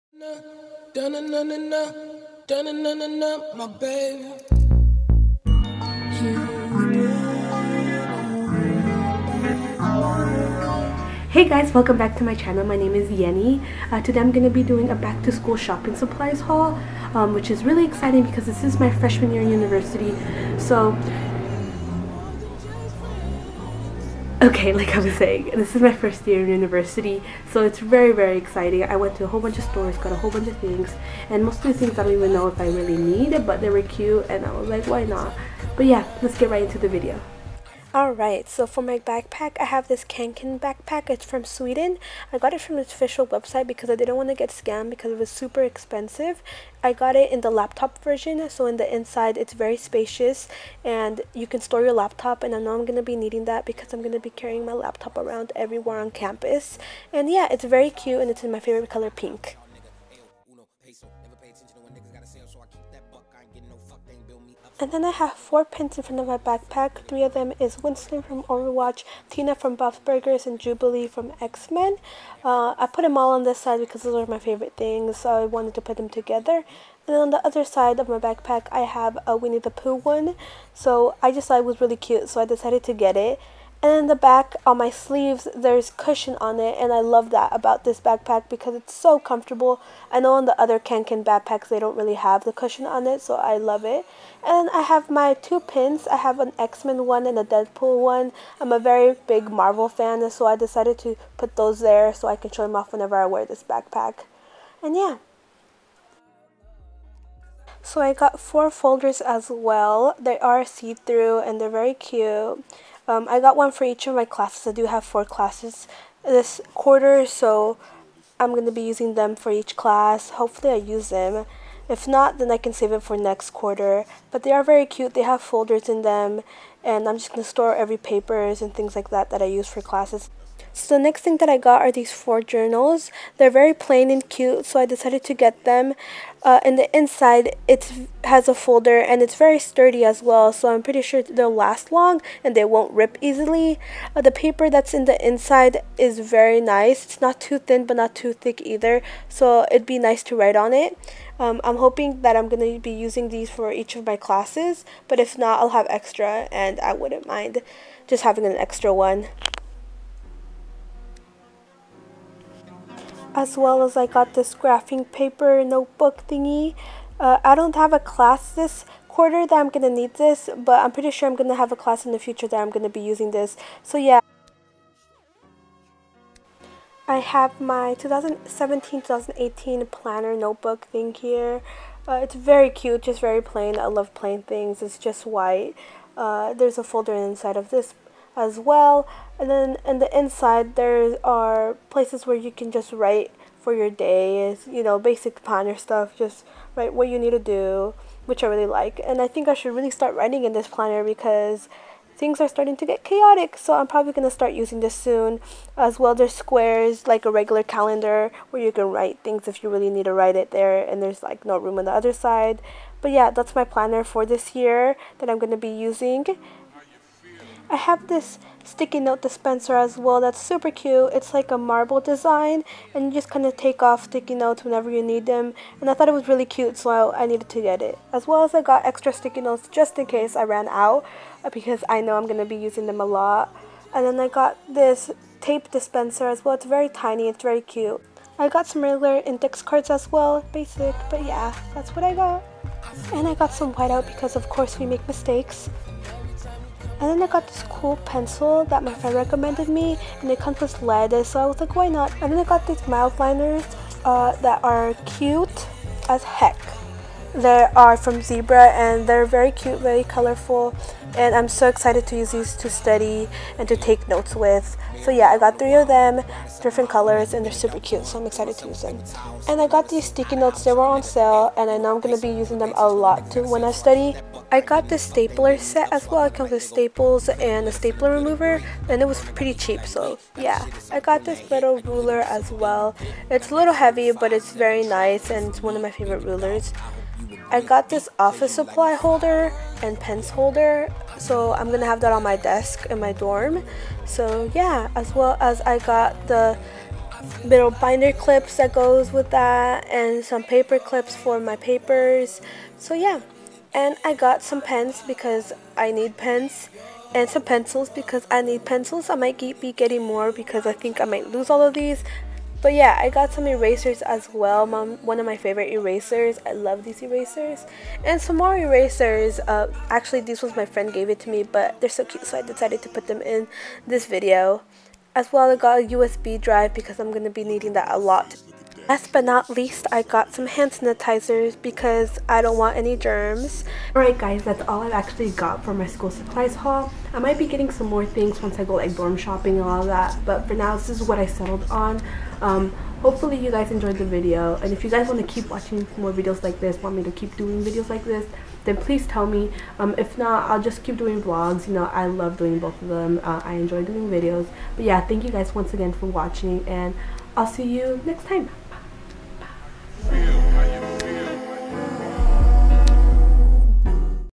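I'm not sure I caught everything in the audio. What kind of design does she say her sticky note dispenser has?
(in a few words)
Marble.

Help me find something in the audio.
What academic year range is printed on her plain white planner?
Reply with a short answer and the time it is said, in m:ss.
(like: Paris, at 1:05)
2017-2018, at 2:57.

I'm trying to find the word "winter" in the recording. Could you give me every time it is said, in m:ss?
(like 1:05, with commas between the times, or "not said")
not said.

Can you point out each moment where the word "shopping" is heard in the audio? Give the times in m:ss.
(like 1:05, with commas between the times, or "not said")
0:15, 5:39.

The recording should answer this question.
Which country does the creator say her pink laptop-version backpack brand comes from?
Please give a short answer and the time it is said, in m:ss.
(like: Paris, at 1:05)
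Sweden, at 0:41.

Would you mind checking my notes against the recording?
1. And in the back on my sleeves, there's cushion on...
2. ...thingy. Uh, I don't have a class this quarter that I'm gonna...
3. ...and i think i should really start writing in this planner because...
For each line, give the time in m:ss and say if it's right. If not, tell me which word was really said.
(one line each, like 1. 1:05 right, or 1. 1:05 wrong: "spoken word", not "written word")
1. 1:23 right
2. 2:46 right
3. 3:19 right.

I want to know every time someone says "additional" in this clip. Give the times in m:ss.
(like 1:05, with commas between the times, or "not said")
not said.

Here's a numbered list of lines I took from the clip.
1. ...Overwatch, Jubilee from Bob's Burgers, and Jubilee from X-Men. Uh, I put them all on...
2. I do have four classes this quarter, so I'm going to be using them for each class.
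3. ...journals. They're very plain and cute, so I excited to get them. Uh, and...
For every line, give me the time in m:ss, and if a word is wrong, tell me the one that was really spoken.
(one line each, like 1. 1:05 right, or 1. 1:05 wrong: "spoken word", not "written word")
1. 1:08 wrong: "Tina", not "Jubilee"
2. 1:54 right
3. 2:12 wrong: "decided", not "excited".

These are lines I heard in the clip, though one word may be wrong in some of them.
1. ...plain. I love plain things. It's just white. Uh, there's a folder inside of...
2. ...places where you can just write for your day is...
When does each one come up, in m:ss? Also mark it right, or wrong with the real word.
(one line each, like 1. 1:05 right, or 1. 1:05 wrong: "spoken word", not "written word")
1. 3:03 right
2. 3:11 right.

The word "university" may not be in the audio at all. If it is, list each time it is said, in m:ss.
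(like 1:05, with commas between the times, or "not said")
0:19, 0:26.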